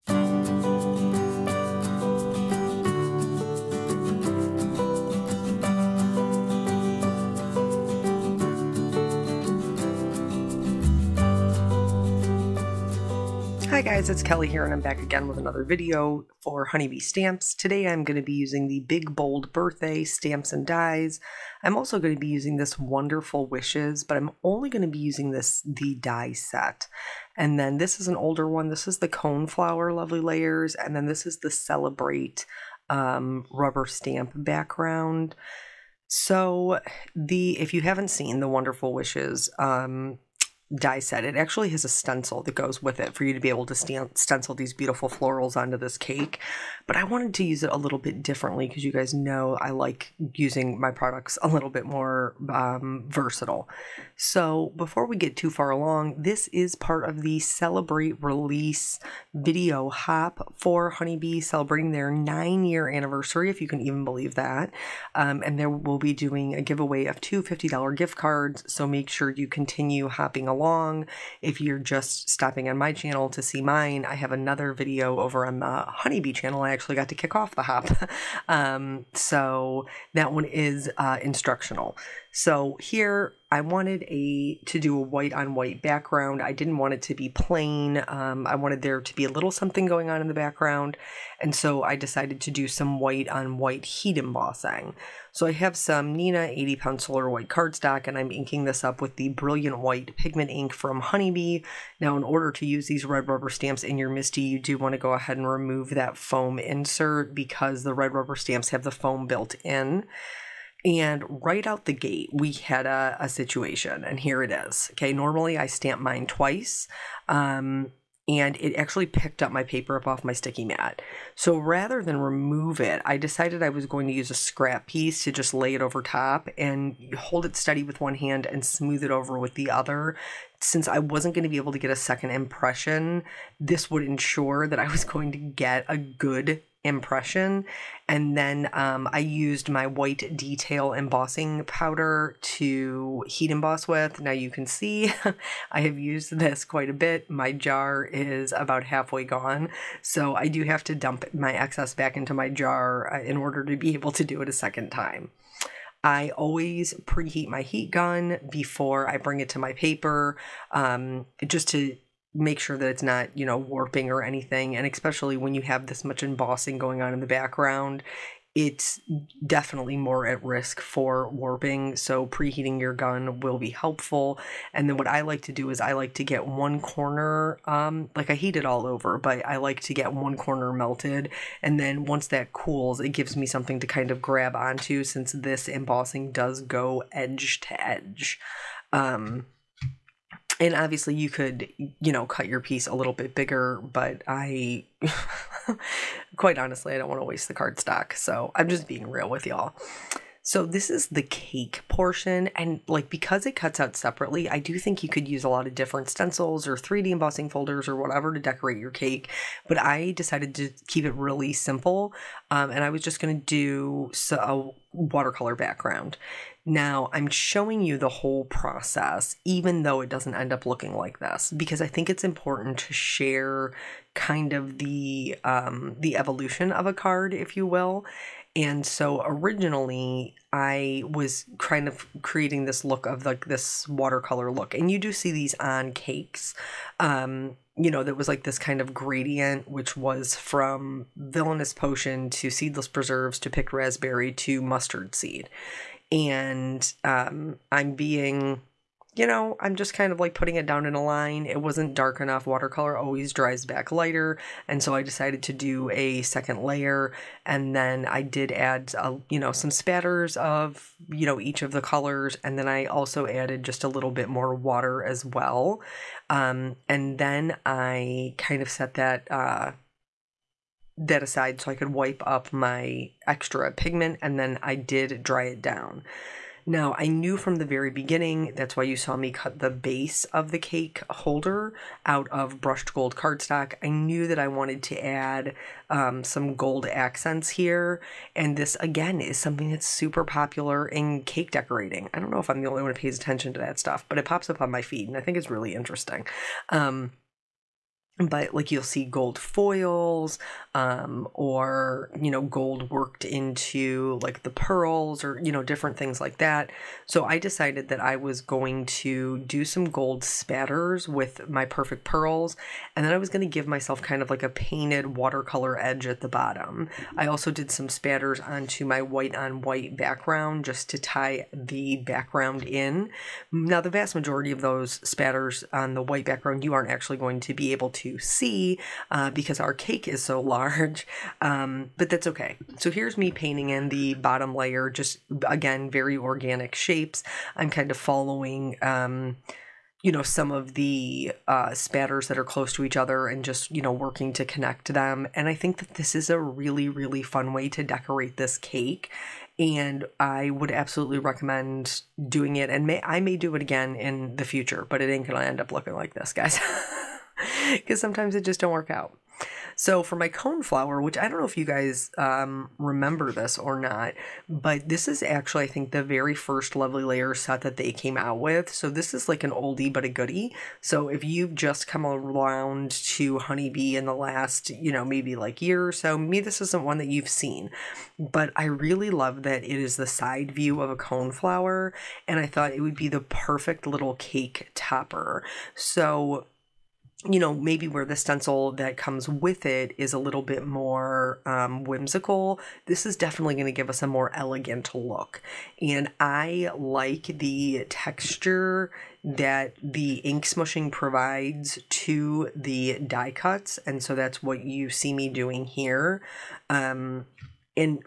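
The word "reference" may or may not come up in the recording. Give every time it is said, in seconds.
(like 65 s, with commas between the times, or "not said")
not said.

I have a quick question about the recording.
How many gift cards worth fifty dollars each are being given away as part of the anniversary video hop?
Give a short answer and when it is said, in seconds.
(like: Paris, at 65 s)
2, at 67 s.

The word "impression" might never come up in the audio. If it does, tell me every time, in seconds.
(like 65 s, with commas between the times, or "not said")
132 s, 136 s.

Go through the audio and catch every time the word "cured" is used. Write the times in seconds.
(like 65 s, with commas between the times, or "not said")
not said.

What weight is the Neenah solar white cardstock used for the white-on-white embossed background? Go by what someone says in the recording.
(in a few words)
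80 pound.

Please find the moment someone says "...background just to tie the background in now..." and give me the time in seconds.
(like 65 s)
319 s.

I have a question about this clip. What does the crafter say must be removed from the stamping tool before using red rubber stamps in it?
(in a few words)
foam insert.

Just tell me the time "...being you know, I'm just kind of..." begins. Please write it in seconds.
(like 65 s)
247 s.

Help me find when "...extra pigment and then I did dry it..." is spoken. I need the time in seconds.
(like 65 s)
273 s.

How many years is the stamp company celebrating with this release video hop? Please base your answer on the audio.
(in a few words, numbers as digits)
9.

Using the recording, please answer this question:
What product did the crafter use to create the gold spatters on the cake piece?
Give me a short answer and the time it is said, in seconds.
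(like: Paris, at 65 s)
Perfect Pearls, at 311 s.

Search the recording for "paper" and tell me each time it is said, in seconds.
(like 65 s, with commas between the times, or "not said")
119 s, 159 s.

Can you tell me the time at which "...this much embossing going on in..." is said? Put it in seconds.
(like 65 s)
165 s.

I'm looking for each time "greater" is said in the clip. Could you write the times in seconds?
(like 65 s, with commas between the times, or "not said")
not said.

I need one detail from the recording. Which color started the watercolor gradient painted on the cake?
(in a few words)
villainous potion.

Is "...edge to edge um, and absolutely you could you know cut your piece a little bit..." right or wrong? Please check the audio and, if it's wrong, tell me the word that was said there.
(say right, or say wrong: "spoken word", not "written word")
wrong: "obviously", not "absolutely".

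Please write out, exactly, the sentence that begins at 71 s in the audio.
If you're just stopping on my channel to see mine, I have another video over on the Honeybee channel.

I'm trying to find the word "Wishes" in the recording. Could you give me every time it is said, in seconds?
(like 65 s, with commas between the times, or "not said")
23 s, 38 s.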